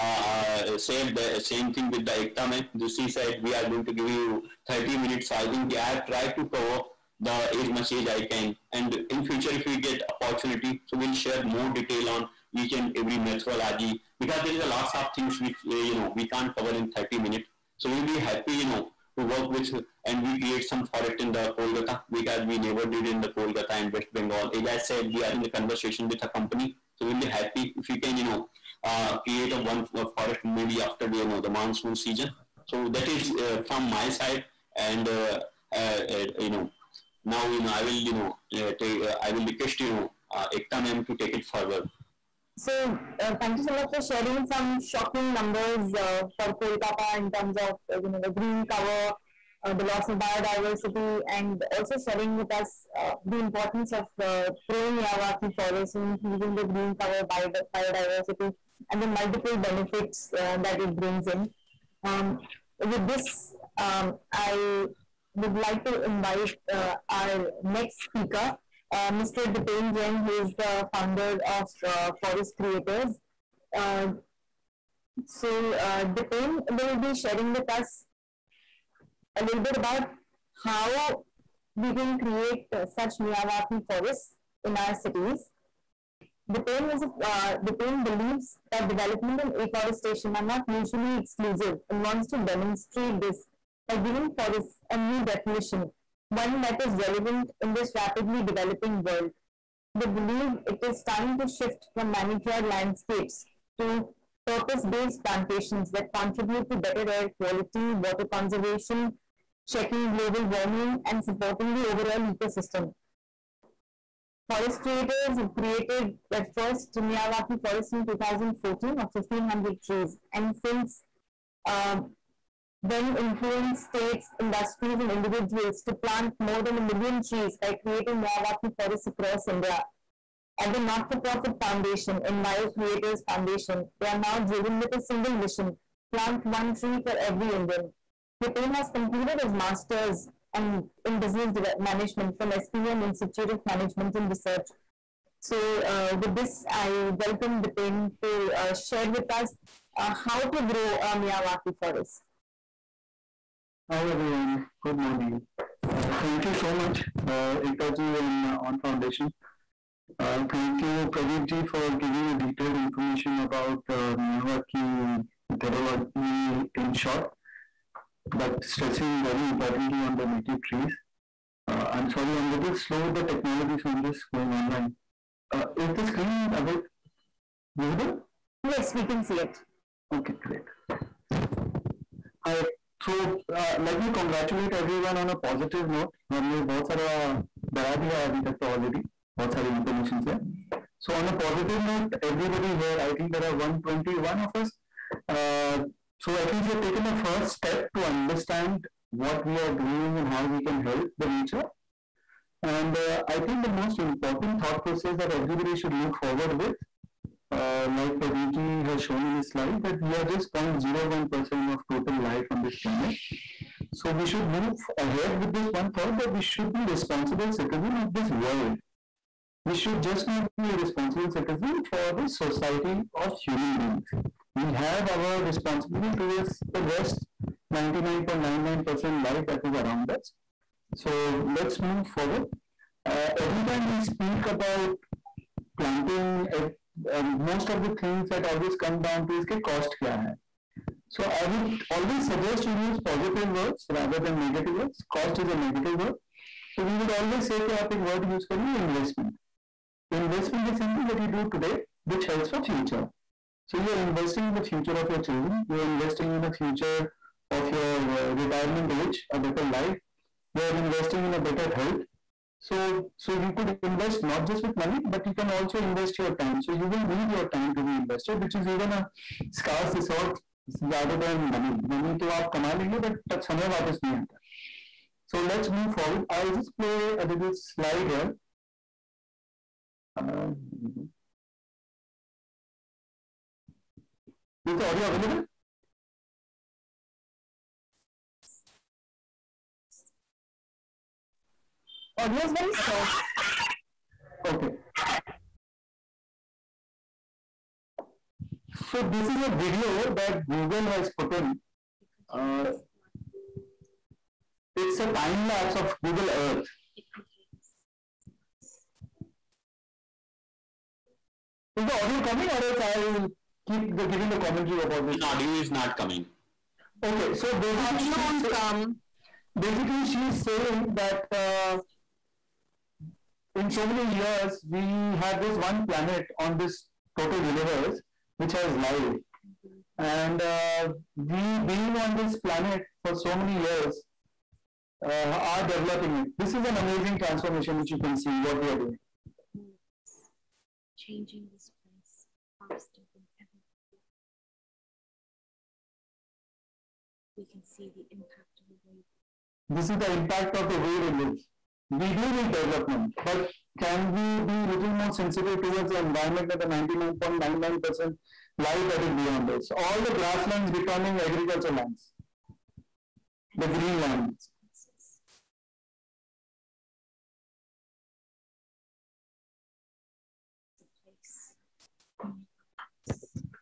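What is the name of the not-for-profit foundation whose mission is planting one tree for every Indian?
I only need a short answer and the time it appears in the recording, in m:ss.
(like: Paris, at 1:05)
Enviro Creators Foundation, at 2:12.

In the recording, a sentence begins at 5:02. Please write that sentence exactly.
Uh, it's a time lapse of Google Earth.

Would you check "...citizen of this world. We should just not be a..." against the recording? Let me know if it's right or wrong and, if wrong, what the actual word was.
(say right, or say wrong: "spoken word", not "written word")
right.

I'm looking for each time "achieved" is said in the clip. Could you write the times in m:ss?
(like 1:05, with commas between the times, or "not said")
not said.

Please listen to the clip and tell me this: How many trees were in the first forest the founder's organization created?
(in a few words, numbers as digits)
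1,500.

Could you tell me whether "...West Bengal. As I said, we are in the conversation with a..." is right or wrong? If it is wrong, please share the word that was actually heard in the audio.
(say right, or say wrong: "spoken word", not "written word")
right.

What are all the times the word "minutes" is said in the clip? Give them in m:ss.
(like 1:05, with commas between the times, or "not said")
0:04, 0:17.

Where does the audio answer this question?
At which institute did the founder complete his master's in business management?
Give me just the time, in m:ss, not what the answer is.
2:22.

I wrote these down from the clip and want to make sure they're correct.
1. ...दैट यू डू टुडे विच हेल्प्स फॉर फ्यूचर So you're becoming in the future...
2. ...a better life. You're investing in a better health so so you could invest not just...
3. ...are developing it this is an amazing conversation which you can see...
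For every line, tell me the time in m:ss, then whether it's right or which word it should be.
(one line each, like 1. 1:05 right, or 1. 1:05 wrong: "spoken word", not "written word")
1. 4:11 wrong: "investing", not "becoming"
2. 4:19 right
3. 5:35 wrong: "transformation", not "conversation".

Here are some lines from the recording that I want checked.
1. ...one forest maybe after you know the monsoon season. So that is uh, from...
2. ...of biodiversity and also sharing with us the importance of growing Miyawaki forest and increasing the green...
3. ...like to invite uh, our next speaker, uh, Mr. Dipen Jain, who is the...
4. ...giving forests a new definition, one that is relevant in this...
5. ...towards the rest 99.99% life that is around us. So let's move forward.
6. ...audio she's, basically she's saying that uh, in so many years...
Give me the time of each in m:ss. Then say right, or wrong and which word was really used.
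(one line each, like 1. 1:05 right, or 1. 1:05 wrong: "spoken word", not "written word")
1. 0:29 right
2. 0:50 right
3. 1:05 right
4. 1:33 right
5. 3:46 right
6. 5:18 right.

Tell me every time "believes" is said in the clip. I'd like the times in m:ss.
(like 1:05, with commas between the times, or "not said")
1:28, 1:40.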